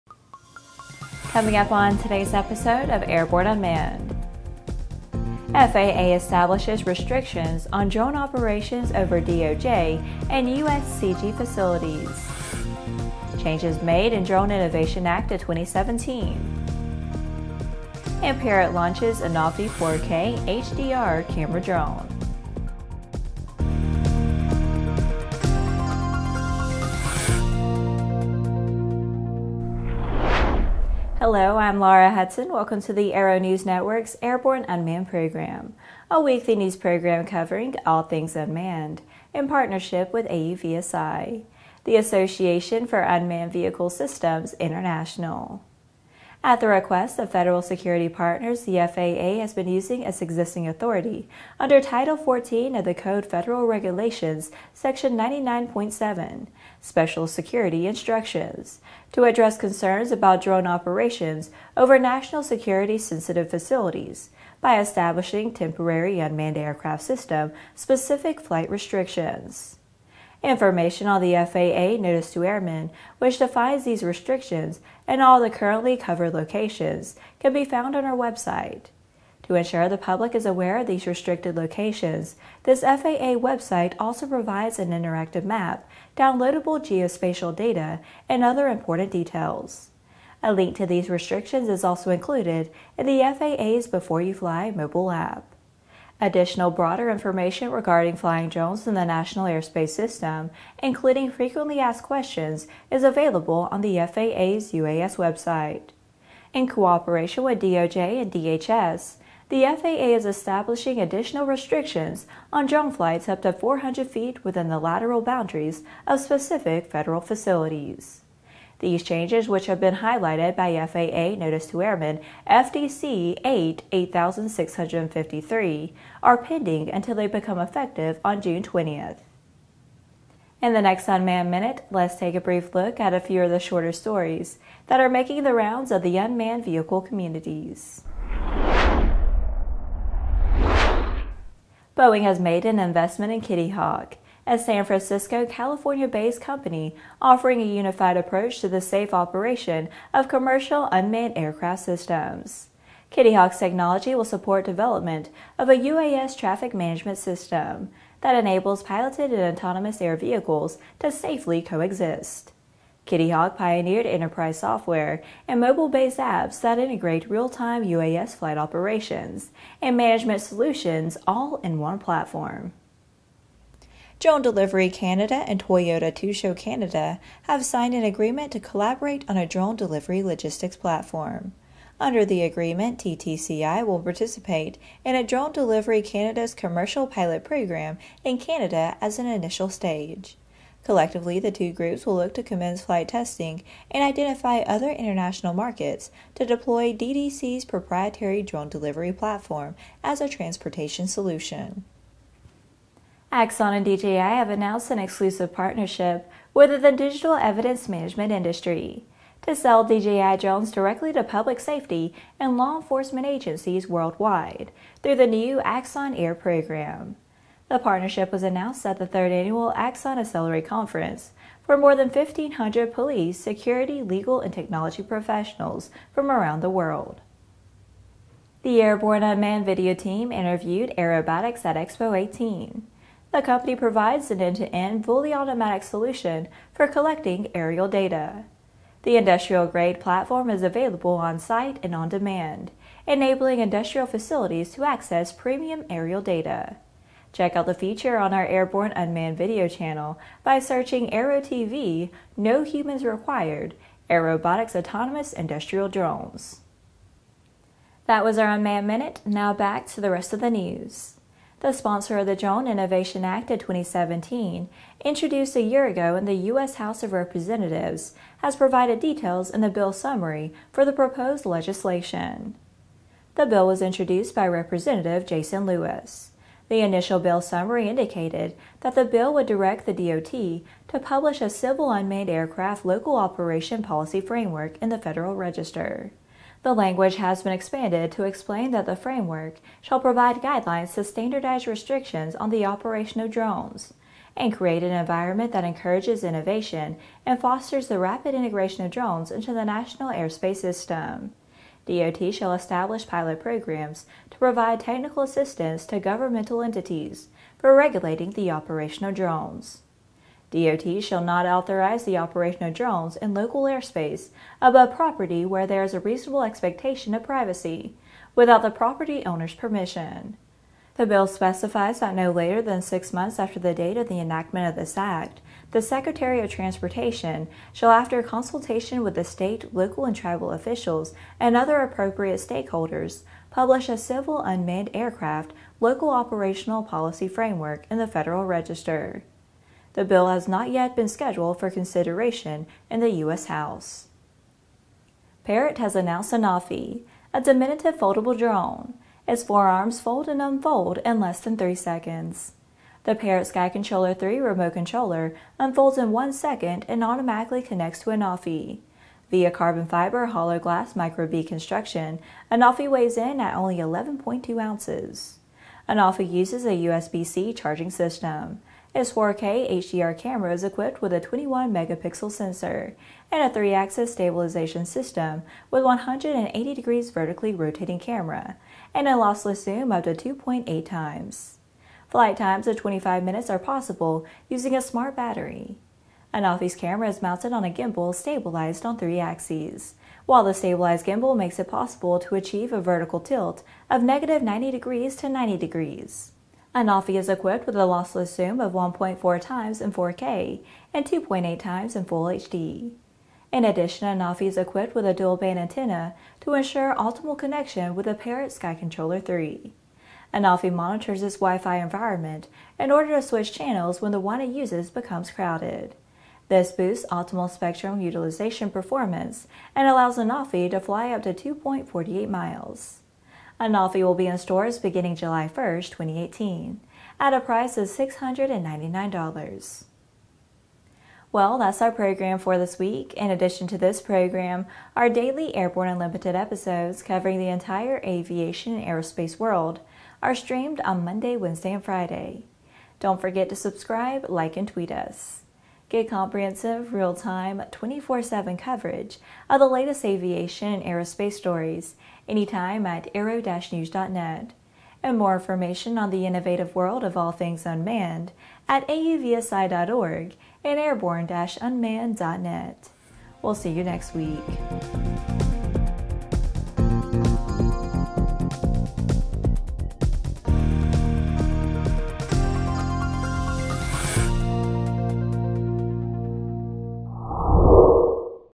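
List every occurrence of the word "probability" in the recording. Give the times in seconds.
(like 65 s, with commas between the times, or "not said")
not said.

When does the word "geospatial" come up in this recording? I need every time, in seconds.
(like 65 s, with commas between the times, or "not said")
86 s.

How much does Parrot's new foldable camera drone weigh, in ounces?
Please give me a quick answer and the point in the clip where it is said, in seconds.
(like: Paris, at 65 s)
11.2 ounces, at 363 s.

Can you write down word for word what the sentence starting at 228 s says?
The Airborne Unmanned Video Team interviewed Airobotics at Expo 18.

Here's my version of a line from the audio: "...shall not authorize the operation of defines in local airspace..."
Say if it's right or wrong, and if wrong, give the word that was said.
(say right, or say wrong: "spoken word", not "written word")
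wrong: "drones", not "defines".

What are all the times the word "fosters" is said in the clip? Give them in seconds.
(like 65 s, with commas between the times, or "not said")
297 s.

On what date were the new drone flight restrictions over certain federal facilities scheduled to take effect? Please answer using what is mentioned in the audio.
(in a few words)
June 20th.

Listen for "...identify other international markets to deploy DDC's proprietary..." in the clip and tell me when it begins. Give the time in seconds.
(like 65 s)
194 s.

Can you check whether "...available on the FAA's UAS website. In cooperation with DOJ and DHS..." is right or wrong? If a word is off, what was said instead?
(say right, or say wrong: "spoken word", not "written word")
right.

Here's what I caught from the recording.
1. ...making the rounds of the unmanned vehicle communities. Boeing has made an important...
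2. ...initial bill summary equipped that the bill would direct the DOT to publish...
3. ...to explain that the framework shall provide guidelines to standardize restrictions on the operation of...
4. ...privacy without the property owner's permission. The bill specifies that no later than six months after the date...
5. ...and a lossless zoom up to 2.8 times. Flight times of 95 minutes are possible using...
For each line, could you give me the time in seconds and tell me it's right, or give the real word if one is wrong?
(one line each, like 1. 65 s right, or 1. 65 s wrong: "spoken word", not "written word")
1. 135 s wrong: "investment", not "important"
2. 276 s wrong: "indicated", not "equipped"
3. 288 s right
4. 317 s right
5. 378 s wrong: "25", not "95".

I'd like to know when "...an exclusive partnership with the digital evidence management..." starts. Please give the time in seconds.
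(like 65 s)
204 s.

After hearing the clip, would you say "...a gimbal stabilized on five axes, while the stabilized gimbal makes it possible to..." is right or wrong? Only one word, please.
wrong.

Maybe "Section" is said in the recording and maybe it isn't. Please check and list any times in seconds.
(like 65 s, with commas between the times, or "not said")
54 s.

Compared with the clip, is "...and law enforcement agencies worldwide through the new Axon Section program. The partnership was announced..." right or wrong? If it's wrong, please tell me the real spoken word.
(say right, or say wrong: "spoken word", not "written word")
wrong: "Air", not "Section".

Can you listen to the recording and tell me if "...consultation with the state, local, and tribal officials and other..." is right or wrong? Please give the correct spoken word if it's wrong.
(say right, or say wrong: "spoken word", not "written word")
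right.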